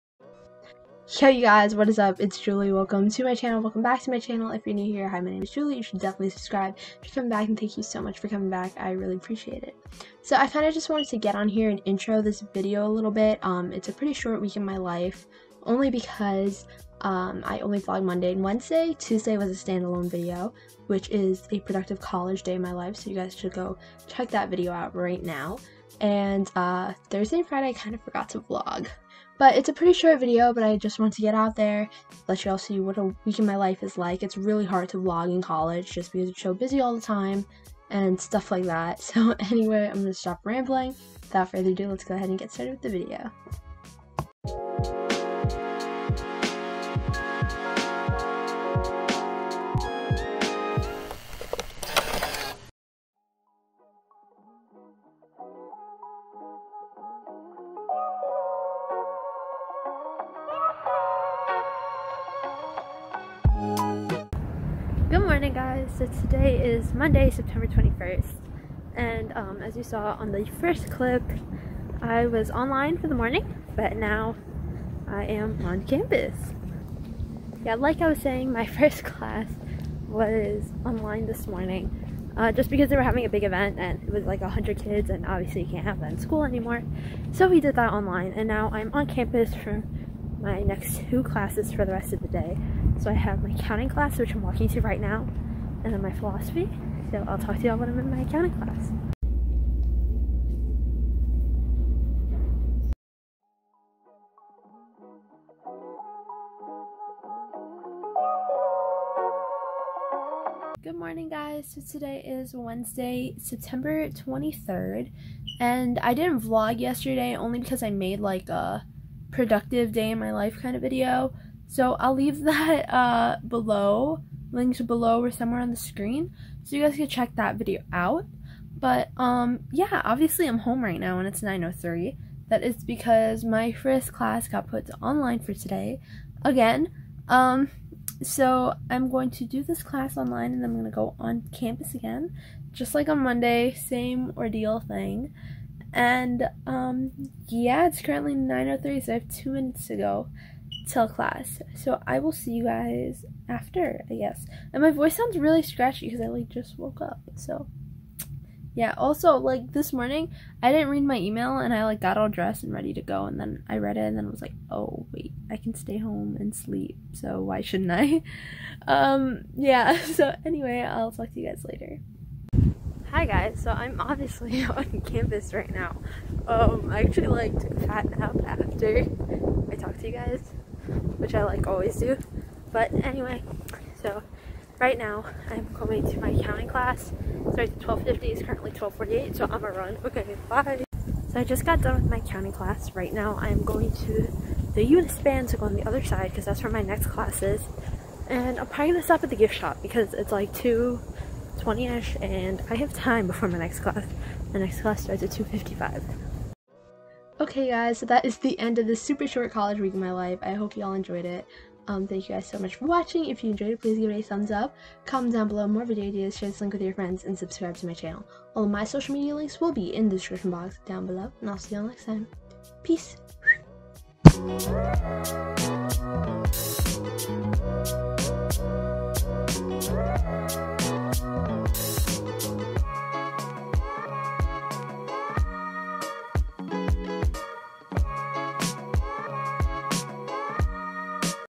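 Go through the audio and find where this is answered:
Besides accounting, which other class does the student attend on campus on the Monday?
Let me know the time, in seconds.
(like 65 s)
96 s.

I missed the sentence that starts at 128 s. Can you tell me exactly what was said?
But um, yeah, obviously I'm home right now and it's 9.03.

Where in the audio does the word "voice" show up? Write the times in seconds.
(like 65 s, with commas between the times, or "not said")
154 s.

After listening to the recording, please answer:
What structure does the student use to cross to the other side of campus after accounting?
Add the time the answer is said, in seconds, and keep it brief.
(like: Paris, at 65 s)
The Unispan, at 194 s.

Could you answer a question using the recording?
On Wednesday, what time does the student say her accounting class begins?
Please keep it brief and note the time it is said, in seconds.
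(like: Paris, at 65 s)
12:50, at 187 s.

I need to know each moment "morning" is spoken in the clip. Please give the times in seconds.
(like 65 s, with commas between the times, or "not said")
65 s, 73 s, 81 s, 110 s, 159 s.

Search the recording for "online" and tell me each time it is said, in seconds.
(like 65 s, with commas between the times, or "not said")
72 s, 80 s, 87 s, 135 s, 140 s.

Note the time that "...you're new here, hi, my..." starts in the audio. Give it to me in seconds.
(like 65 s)
4 s.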